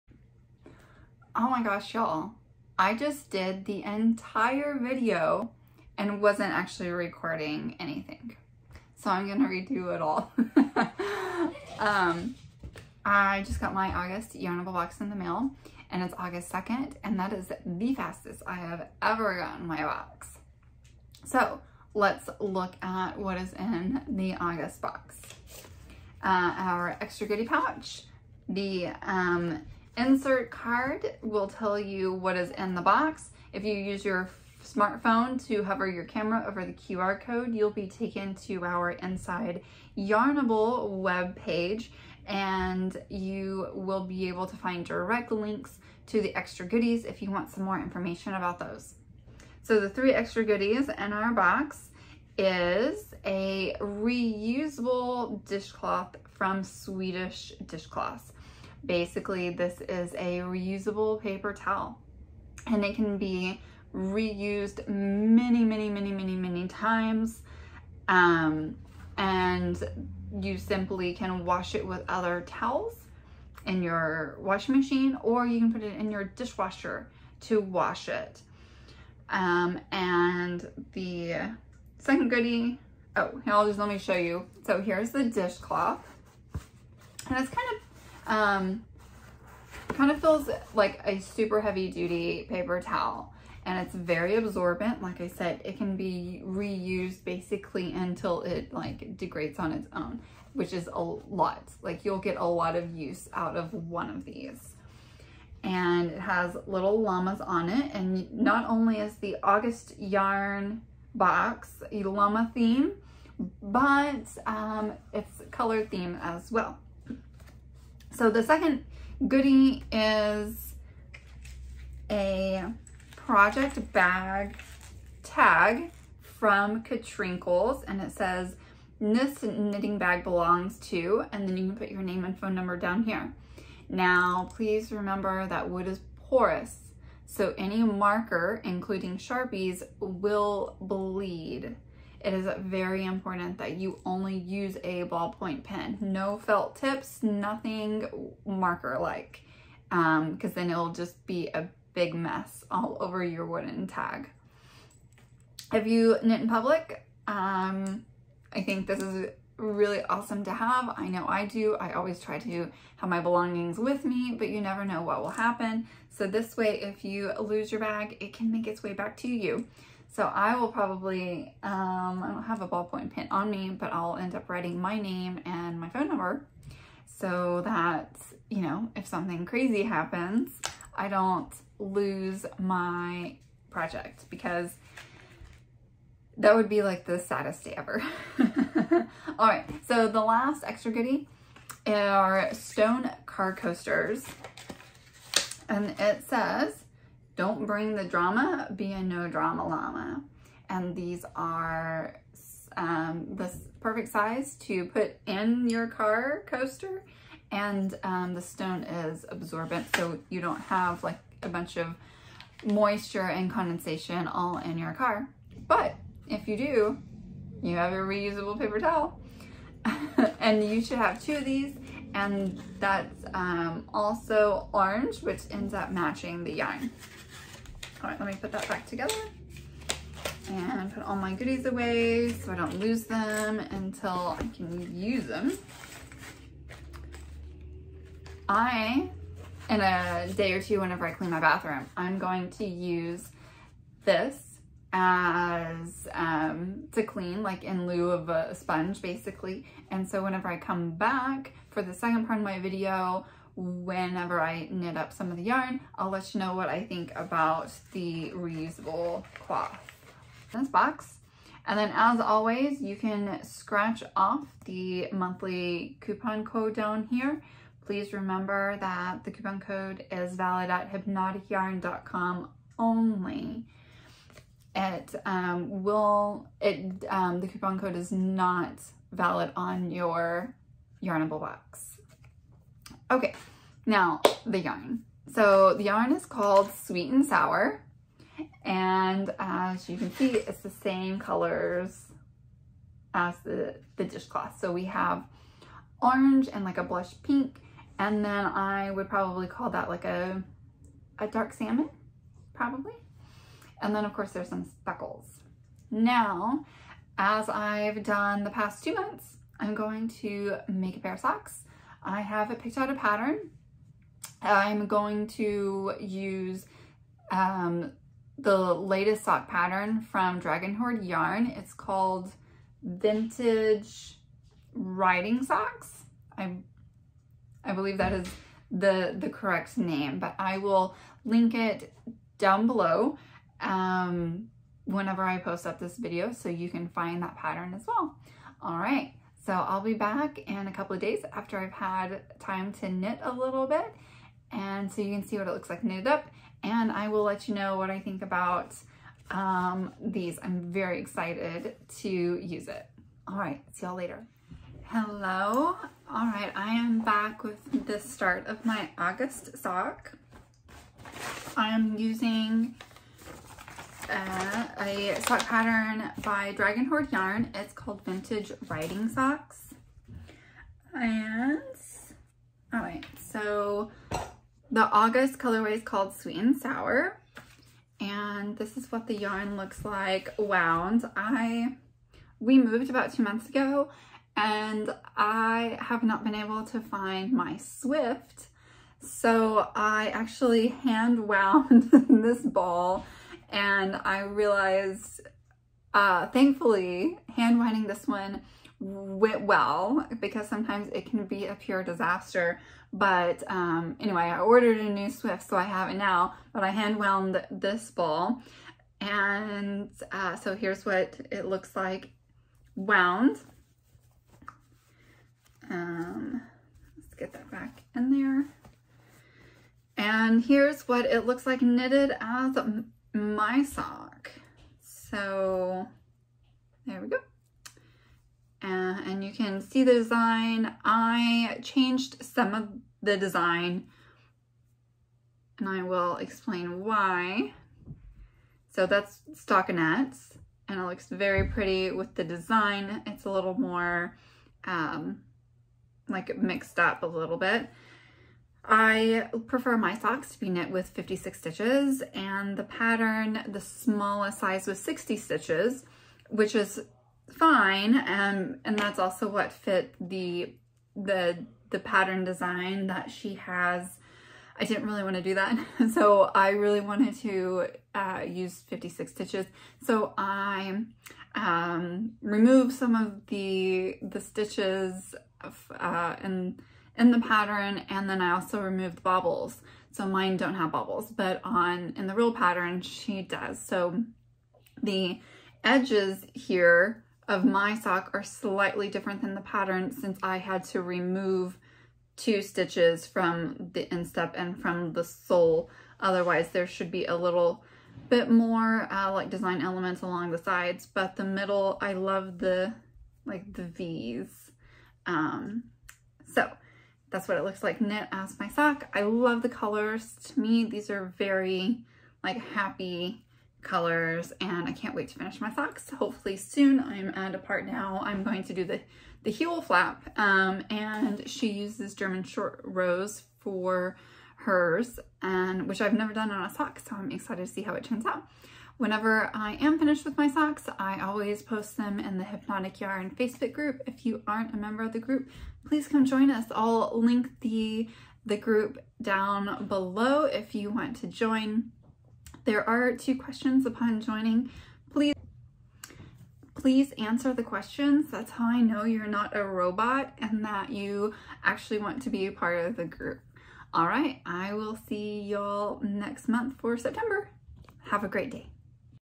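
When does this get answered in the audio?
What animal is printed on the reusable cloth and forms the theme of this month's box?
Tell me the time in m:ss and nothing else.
1:47.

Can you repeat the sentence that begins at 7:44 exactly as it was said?
I didn't really want to do that.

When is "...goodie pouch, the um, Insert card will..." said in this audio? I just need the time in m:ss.
0:27.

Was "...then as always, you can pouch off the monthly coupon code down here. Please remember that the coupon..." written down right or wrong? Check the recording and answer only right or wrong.
wrong.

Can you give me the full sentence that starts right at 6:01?
I'm using uh, a sock pattern by Dragon Hoard Yarn.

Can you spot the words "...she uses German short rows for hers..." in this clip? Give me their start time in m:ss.
8:41.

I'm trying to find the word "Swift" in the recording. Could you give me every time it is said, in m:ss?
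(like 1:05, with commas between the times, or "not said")
6:27, 6:45.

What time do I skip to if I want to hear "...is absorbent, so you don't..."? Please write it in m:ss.
3:28.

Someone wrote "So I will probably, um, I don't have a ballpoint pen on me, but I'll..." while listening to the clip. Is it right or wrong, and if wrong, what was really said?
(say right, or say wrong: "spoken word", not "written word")
right.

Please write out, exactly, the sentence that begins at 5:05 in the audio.
Now, as I've done the past two months, I'm going to make a pair of socks.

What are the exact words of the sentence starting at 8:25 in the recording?
Um, so that's what it looks like knit as my sock.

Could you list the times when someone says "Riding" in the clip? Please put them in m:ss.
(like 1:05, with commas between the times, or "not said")
5:24, 6:08.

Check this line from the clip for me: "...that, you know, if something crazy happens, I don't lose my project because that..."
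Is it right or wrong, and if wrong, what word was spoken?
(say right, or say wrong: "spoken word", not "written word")
right.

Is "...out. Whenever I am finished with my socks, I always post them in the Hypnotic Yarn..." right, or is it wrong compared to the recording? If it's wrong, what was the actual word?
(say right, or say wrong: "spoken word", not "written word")
right.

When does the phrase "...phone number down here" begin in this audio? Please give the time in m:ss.
2:12.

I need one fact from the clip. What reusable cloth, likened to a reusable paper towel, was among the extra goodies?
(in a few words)
Swedish Dishcloths.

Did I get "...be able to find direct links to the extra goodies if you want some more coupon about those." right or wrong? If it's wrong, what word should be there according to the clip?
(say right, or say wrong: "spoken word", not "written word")
wrong: "information", not "coupon".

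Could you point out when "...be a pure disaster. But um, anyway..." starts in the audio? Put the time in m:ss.
6:41.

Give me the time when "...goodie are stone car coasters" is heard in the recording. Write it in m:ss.
3:10.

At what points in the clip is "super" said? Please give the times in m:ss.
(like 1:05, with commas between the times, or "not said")
1:31.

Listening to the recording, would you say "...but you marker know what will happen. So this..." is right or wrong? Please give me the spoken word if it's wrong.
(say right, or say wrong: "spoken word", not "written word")
wrong: "never", not "marker".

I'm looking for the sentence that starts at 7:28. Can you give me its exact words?
I prefer my socks to be knit with 56 stitches and the pattern, the smallest size was 60 stitches, which is fine.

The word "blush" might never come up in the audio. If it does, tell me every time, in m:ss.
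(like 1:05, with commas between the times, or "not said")
4:56.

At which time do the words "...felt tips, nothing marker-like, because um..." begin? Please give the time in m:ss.
2:26.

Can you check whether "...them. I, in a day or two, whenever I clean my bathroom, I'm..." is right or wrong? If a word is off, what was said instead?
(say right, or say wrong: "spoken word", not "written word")
right.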